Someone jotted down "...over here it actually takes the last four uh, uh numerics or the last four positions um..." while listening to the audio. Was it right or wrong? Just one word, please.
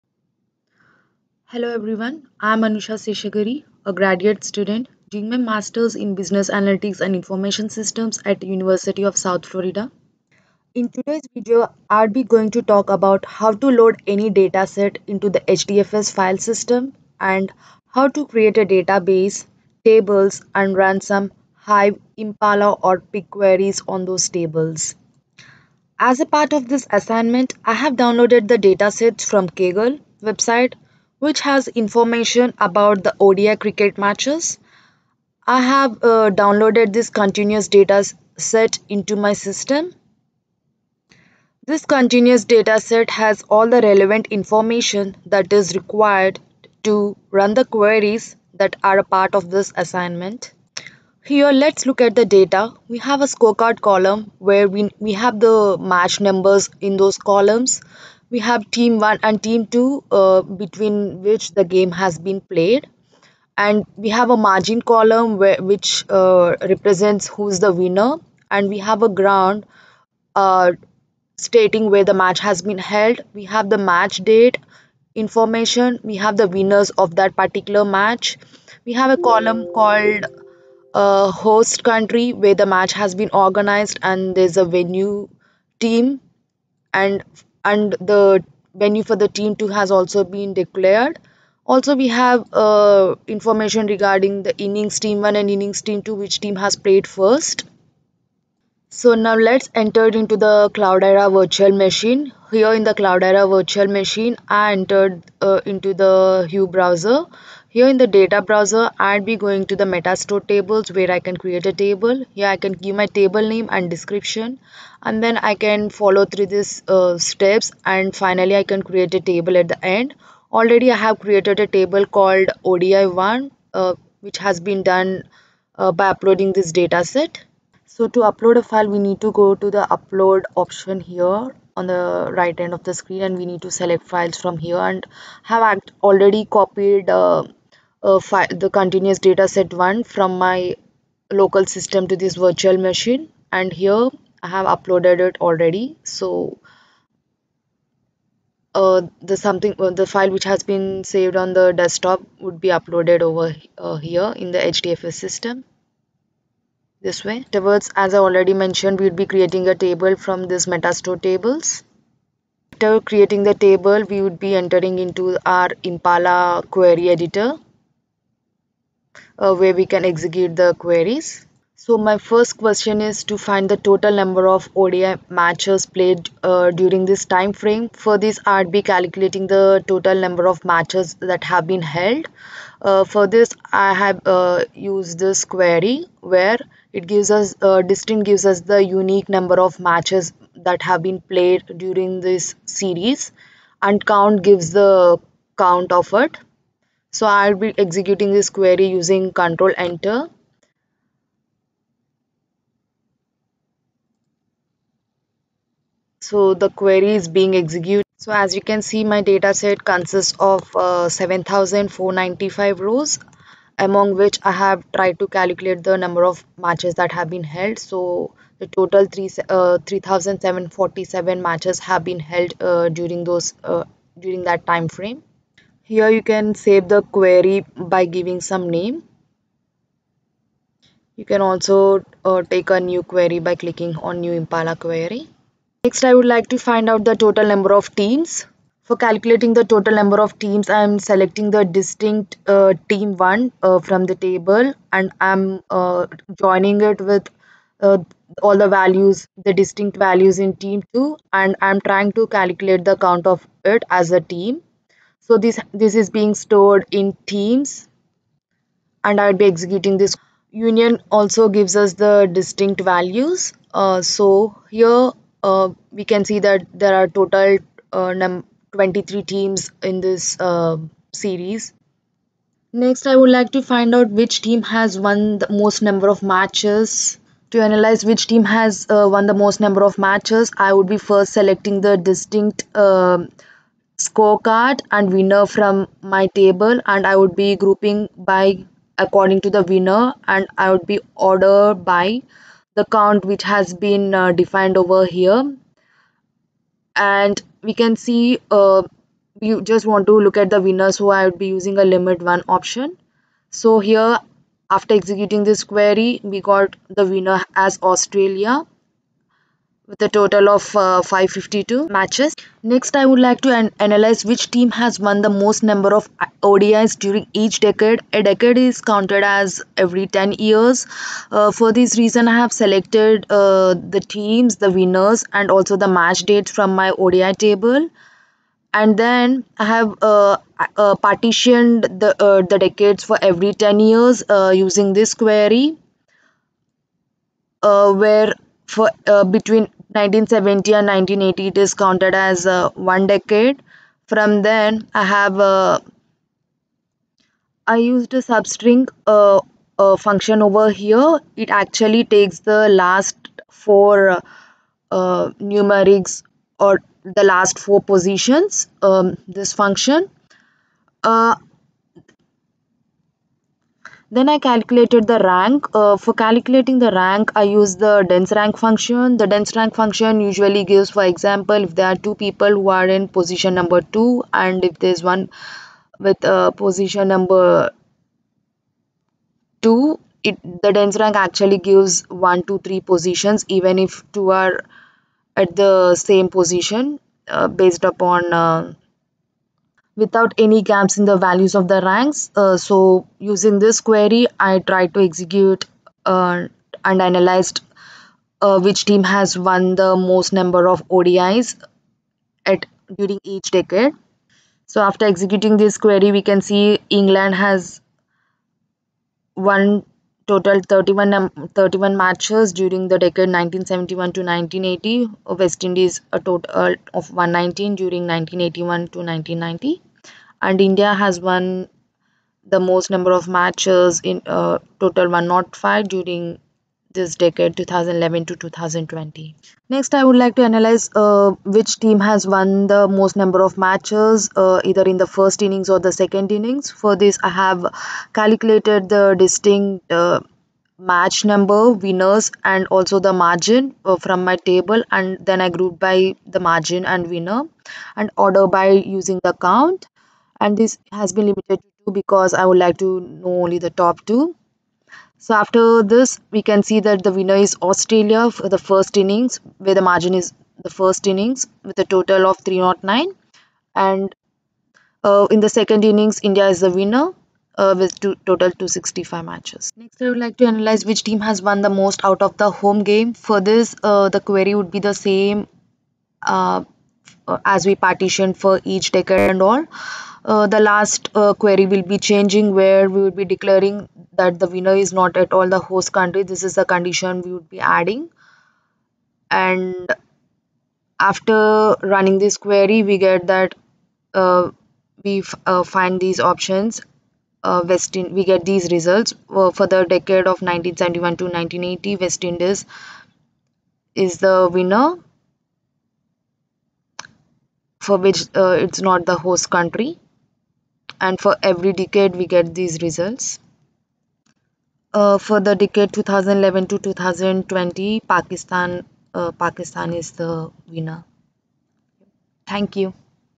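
right.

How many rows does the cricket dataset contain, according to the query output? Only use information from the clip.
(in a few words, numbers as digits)
7,495.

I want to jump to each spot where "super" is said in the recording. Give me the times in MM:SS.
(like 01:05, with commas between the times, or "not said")
not said.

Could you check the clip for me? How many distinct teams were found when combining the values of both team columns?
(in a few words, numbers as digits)
23.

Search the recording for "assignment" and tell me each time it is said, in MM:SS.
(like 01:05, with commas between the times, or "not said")
00:26, 00:49.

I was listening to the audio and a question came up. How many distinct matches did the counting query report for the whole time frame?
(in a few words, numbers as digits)
3,747.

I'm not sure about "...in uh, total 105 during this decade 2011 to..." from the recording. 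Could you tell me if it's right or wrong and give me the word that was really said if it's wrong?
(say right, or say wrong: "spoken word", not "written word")
right.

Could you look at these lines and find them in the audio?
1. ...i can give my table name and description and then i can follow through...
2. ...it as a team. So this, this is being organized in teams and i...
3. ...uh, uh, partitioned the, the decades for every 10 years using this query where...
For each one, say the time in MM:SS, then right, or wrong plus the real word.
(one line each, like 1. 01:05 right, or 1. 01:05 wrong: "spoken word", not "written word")
1. 01:52 right
2. 04:13 wrong: "stored", not "organized"
3. 05:30 right.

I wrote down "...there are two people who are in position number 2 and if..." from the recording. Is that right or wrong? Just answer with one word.
right.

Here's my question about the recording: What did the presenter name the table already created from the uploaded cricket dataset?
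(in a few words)
odi1.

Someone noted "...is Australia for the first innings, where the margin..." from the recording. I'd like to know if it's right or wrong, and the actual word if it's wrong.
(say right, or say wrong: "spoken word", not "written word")
right.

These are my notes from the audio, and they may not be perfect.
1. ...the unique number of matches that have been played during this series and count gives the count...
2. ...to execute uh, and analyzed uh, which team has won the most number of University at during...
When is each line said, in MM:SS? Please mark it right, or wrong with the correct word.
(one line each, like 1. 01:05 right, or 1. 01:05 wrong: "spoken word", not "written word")
1. 03:08 right
2. 06:34 wrong: "ODIs", not "University".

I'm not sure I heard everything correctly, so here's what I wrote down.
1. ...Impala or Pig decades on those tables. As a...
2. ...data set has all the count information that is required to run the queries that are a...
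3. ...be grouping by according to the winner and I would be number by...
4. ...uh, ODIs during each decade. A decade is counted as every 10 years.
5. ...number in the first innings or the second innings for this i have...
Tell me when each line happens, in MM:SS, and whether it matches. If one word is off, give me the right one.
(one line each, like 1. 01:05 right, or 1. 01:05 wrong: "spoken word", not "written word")
1. 00:22 wrong: "queries", not "decades"
2. 00:42 wrong: "relevant", not "count"
3. 04:47 wrong: "order", not "number"
4. 05:16 right
5. 07:14 wrong: "either", not "number".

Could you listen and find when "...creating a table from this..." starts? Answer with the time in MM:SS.
02:39.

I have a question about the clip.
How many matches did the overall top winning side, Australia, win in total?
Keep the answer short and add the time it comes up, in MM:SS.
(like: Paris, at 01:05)
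552, at 05:11.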